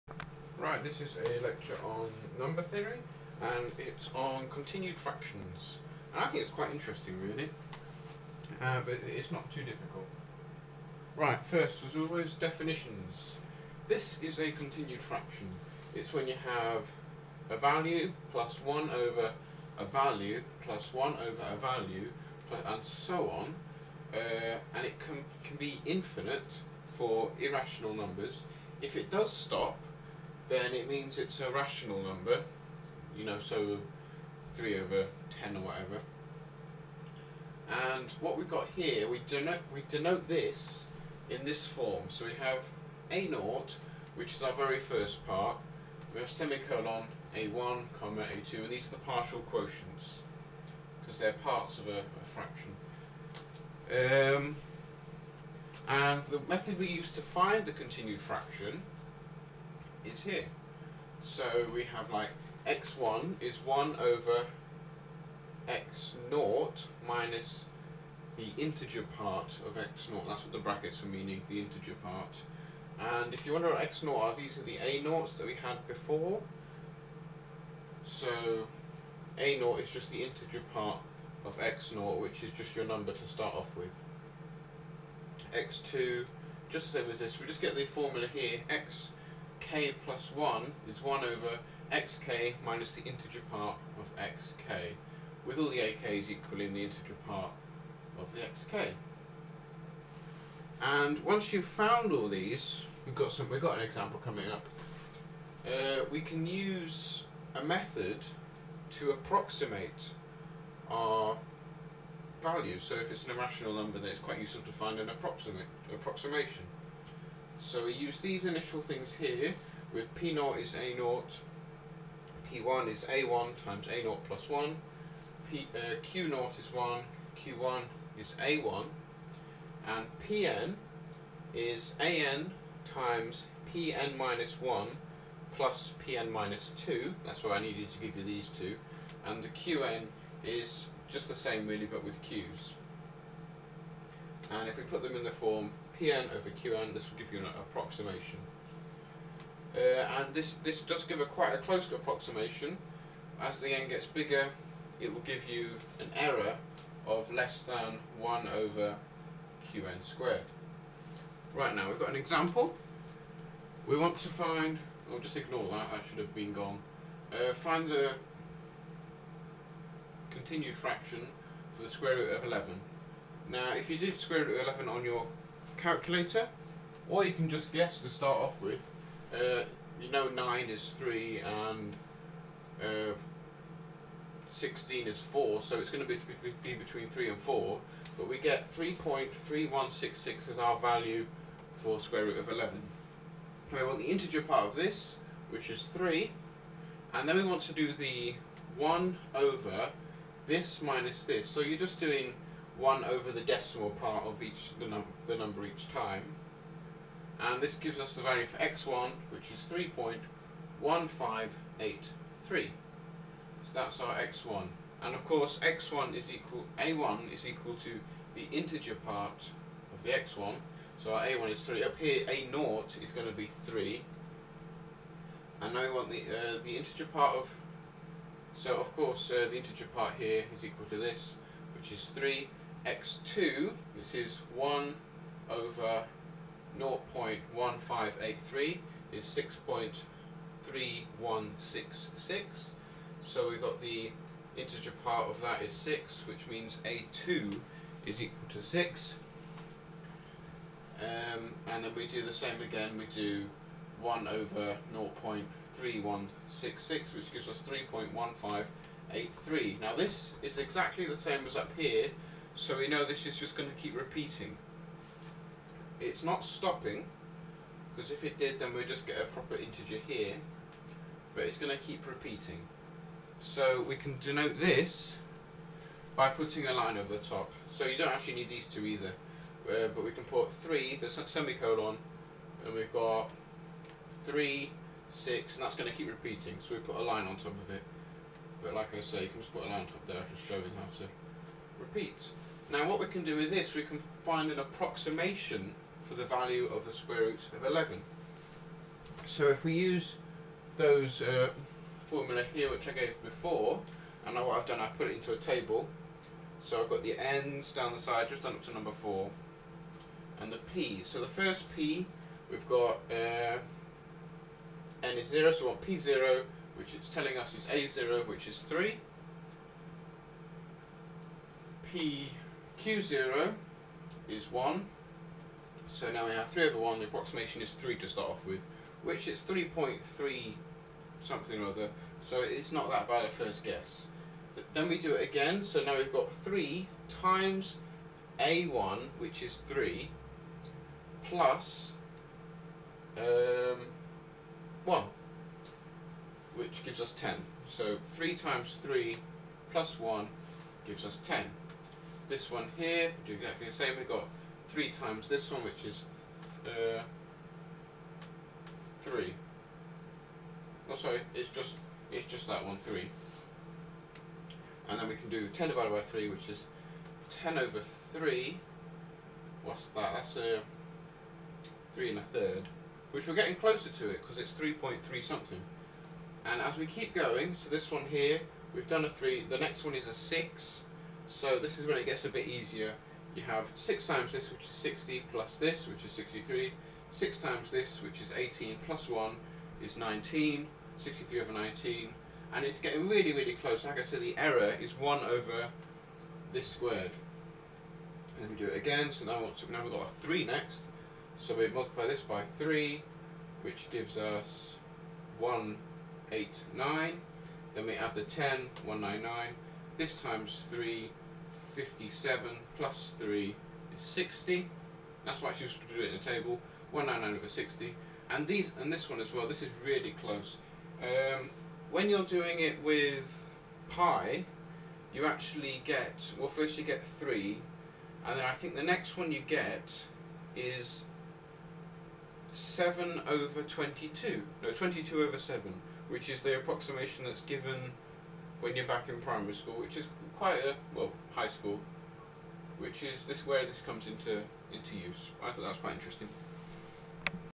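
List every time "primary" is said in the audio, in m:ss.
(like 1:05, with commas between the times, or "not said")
7:19.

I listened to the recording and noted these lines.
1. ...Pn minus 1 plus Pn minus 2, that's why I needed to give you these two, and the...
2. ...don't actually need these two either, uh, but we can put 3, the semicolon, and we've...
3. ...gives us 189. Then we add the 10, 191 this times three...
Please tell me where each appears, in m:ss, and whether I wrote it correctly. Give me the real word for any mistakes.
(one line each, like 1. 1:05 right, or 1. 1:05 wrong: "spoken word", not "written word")
1. 2:13 right
2. 4:37 right
3. 6:43 wrong: "199", not "191".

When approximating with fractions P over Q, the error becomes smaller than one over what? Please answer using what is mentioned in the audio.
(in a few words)
Qn squared.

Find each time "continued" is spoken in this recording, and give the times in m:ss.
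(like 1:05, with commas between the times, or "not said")
0:04, 0:14, 0:57, 2:50.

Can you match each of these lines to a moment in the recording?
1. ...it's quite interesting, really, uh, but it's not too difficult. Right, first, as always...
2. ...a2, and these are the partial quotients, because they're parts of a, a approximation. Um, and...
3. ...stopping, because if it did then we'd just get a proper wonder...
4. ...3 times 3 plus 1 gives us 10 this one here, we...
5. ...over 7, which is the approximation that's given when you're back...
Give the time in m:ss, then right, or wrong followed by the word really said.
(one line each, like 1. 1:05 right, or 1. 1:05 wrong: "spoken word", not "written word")
1. 0:06 right
2. 0:48 wrong: "fraction", not "approximation"
3. 4:26 wrong: "integer", not "wonder"
4. 5:48 right
5. 7:15 right.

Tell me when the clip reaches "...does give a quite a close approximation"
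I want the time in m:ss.
2:30.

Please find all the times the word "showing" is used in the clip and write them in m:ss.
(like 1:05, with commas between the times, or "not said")
4:50.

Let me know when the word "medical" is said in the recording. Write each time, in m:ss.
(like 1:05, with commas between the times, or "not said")
not said.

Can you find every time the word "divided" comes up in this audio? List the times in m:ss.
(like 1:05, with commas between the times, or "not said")
6:05.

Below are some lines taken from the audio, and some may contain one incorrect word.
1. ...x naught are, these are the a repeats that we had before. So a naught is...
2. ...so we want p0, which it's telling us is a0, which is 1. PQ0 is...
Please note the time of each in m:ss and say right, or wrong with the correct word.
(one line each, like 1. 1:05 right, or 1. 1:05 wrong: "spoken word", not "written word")
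1. 1:13 wrong: "naughts", not "repeats"
2. 5:15 wrong: "3", not "1".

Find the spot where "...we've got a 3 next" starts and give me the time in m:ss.
6:39.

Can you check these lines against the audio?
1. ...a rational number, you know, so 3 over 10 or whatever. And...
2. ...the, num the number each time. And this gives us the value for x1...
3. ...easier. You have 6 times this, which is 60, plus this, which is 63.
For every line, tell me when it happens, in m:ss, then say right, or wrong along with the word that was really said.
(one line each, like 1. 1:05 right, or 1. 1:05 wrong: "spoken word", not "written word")
1. 0:31 right
2. 3:24 right
3. 6:22 right.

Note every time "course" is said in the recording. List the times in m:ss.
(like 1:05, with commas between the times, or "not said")
3:35, 3:48.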